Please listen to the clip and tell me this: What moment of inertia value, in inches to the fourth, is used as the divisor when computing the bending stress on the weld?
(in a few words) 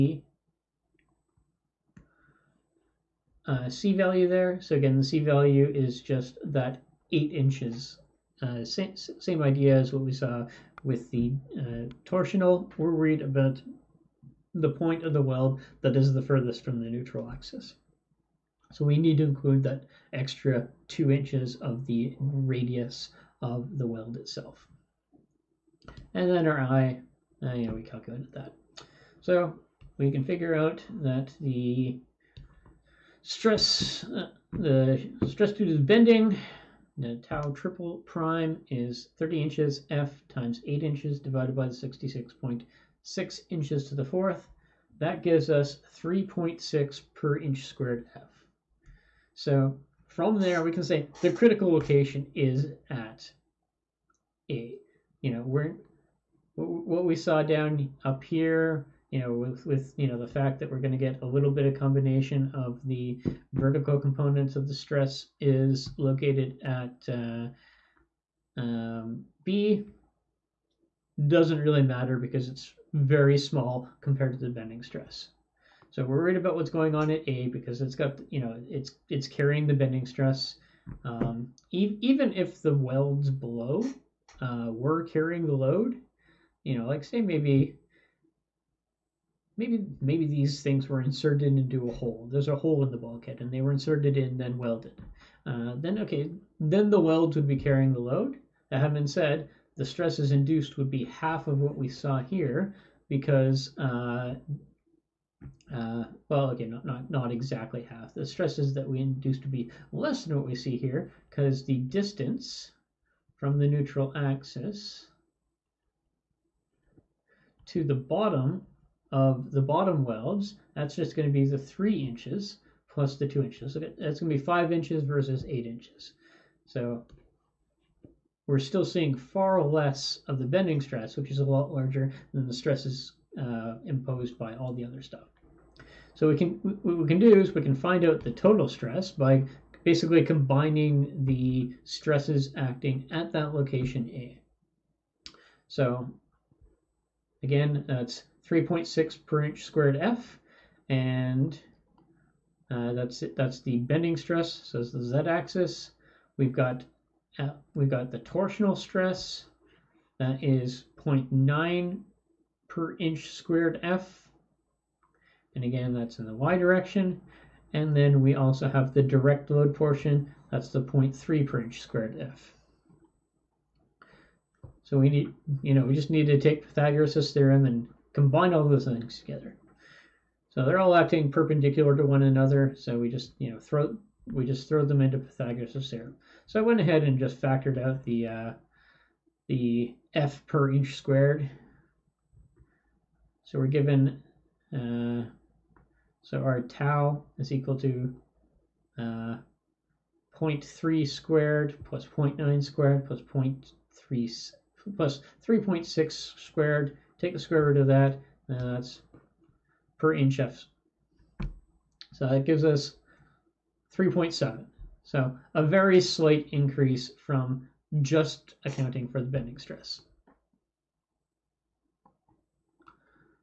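66.6.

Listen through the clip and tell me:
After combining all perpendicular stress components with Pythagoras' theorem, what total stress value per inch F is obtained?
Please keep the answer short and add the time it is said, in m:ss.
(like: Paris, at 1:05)
3.7, at 3:33.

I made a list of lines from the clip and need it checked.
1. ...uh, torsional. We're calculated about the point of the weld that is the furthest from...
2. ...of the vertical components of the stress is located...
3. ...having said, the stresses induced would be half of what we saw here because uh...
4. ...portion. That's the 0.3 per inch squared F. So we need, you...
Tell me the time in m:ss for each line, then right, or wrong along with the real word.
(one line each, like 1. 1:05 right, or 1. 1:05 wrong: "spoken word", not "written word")
1. 0:11 wrong: "worried", not "calculated"
2. 1:02 right
3. 1:38 right
4. 2:49 right.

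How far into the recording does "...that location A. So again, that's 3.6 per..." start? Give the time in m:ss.
2:23.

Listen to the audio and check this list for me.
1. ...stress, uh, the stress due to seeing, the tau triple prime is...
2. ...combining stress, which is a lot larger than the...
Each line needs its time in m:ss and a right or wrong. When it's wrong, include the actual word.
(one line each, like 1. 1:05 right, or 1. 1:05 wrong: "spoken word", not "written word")
1. 0:33 wrong: "bending", not "seeing"
2. 2:10 wrong: "bending", not "combining".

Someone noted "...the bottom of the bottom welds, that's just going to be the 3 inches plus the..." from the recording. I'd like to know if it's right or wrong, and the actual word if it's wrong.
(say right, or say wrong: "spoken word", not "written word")
right.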